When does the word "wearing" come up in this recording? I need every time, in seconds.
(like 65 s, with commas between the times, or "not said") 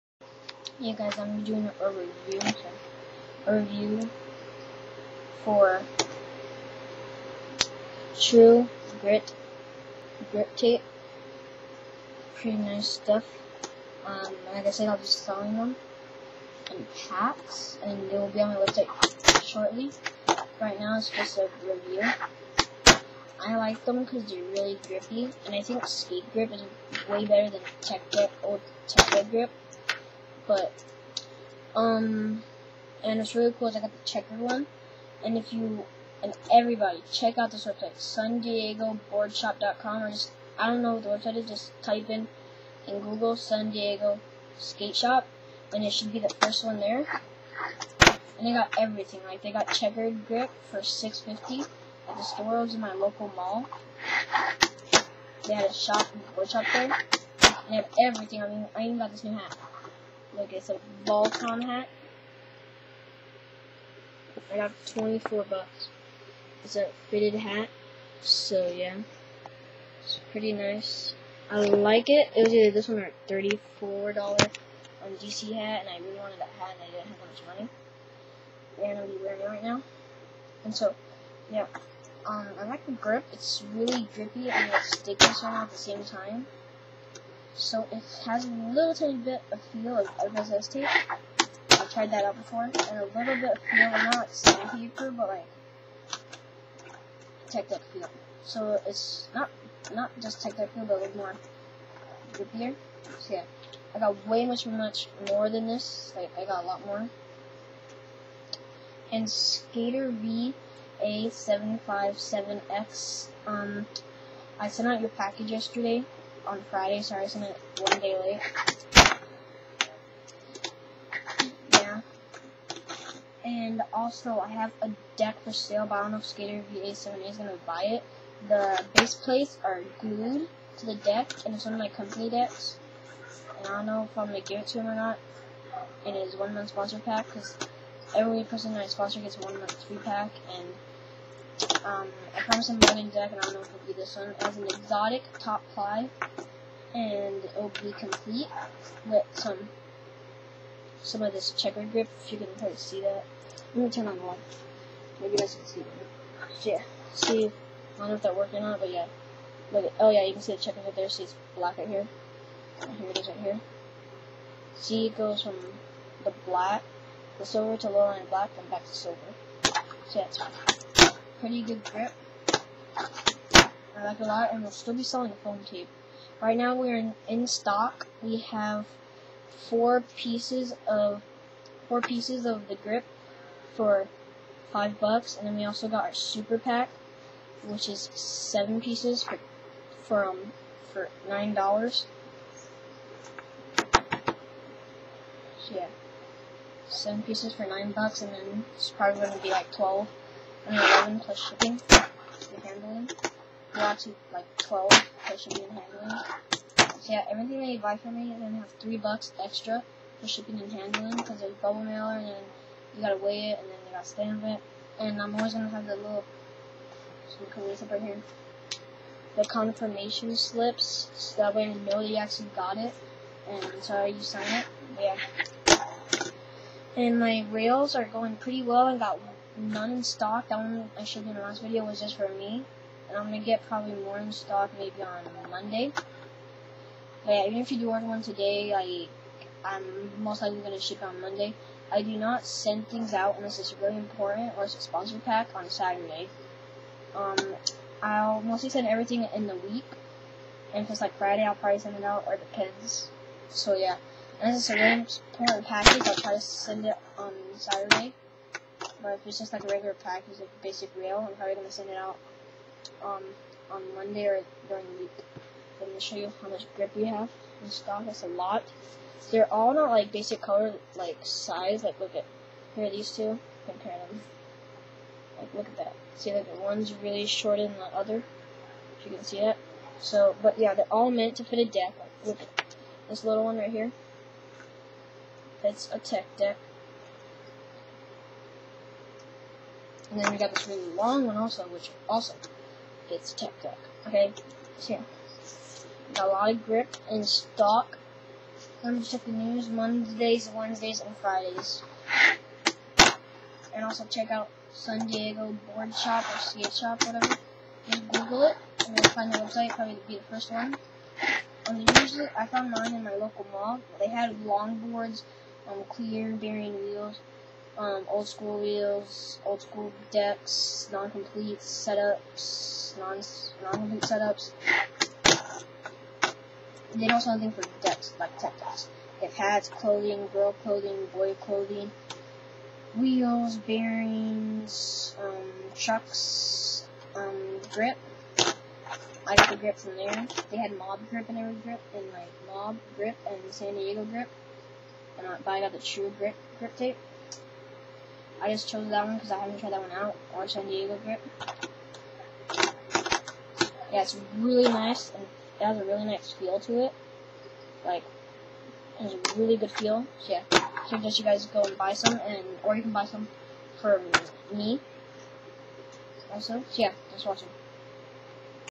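79 s.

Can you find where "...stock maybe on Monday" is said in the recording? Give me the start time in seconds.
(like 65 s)
234 s.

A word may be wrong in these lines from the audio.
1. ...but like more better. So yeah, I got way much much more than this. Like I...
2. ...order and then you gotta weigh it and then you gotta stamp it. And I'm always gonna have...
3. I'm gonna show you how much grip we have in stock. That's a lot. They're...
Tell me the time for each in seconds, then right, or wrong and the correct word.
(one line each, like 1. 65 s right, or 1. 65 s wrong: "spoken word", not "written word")
1. 100 s wrong: "grippier", not "better"
2. 211 s wrong: "mailer", not "order"
3. 265 s right.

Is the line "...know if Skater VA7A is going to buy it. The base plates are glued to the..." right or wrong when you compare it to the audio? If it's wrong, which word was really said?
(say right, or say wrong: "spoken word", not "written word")
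right.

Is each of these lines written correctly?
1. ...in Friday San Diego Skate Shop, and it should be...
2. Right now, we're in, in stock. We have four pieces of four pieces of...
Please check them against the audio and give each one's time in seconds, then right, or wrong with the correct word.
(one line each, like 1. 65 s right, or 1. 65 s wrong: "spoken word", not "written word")
1. 42 s wrong: "Google", not "Friday"
2. 176 s right.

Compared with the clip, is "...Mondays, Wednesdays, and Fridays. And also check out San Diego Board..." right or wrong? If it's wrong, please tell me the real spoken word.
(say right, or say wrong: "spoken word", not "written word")
right.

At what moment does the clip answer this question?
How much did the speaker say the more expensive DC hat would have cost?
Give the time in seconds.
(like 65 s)
73 s.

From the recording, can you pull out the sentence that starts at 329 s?
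They have hats, clothing, girl clothing, boy clothing, wheels, bearings, um, trucks, um, grip.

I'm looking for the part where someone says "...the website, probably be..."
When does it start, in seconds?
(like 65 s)
309 s.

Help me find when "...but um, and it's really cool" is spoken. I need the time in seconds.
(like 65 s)
30 s.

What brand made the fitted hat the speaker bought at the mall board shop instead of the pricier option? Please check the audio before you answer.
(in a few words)
Volcom.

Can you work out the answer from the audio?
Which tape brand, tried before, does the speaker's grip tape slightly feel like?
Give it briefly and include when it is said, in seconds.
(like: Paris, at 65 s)
RSS tape, at 90 s.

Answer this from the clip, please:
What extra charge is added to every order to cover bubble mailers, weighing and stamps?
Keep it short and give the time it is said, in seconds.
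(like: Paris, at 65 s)
$3, at 208 s.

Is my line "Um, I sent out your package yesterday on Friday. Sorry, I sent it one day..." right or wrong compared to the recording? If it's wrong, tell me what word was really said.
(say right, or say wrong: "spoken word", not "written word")
right.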